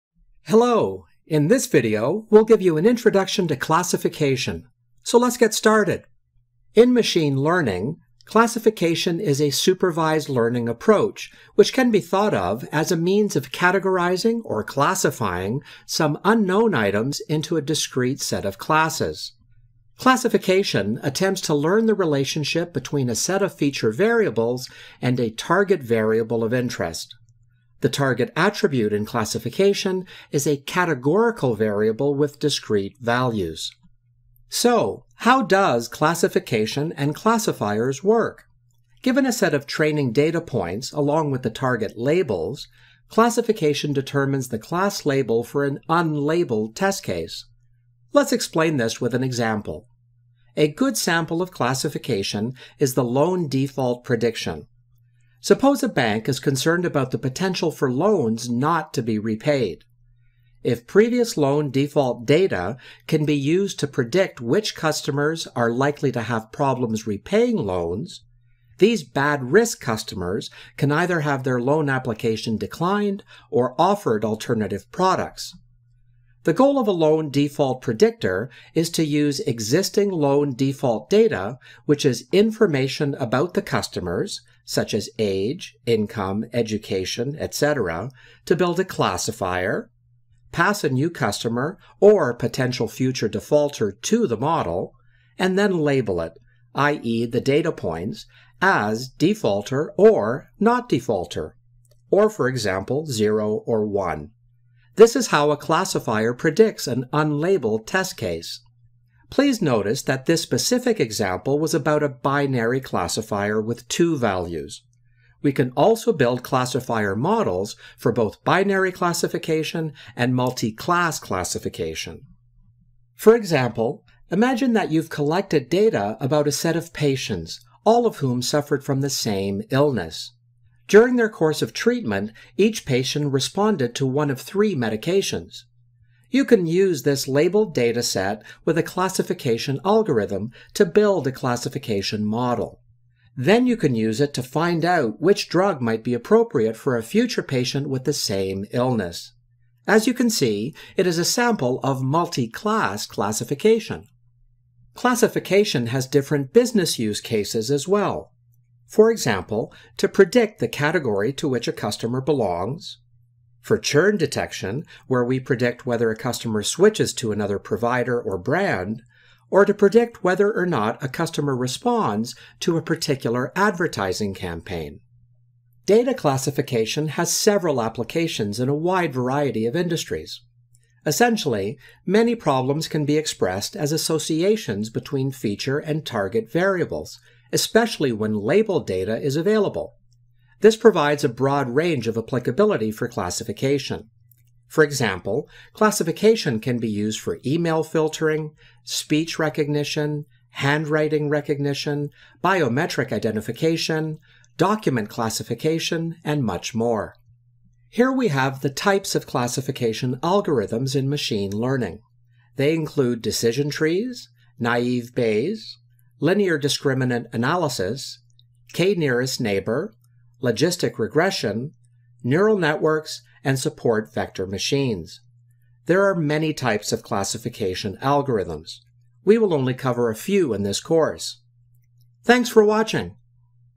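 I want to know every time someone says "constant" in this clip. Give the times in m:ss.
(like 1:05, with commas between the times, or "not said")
not said.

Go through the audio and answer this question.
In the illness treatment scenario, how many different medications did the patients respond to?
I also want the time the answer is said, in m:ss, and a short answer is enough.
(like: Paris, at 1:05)
3, at 2:14.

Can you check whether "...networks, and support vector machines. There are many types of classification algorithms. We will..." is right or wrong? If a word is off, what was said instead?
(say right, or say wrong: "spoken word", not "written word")
right.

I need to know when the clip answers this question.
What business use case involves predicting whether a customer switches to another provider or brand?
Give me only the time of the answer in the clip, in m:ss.
2:43.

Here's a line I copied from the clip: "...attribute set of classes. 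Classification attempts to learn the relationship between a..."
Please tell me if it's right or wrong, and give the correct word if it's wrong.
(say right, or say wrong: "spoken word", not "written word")
wrong: "discrete", not "attribute".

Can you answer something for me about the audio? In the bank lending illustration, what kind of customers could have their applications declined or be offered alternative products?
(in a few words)
bad risk customers.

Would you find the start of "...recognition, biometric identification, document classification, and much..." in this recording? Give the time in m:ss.
3:21.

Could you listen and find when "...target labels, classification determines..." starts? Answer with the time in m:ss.
0:41.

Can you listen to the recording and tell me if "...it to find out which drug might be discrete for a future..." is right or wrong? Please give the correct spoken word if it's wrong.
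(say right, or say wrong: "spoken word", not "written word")
wrong: "appropriate", not "discrete".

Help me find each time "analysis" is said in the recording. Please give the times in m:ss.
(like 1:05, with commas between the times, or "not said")
3:37.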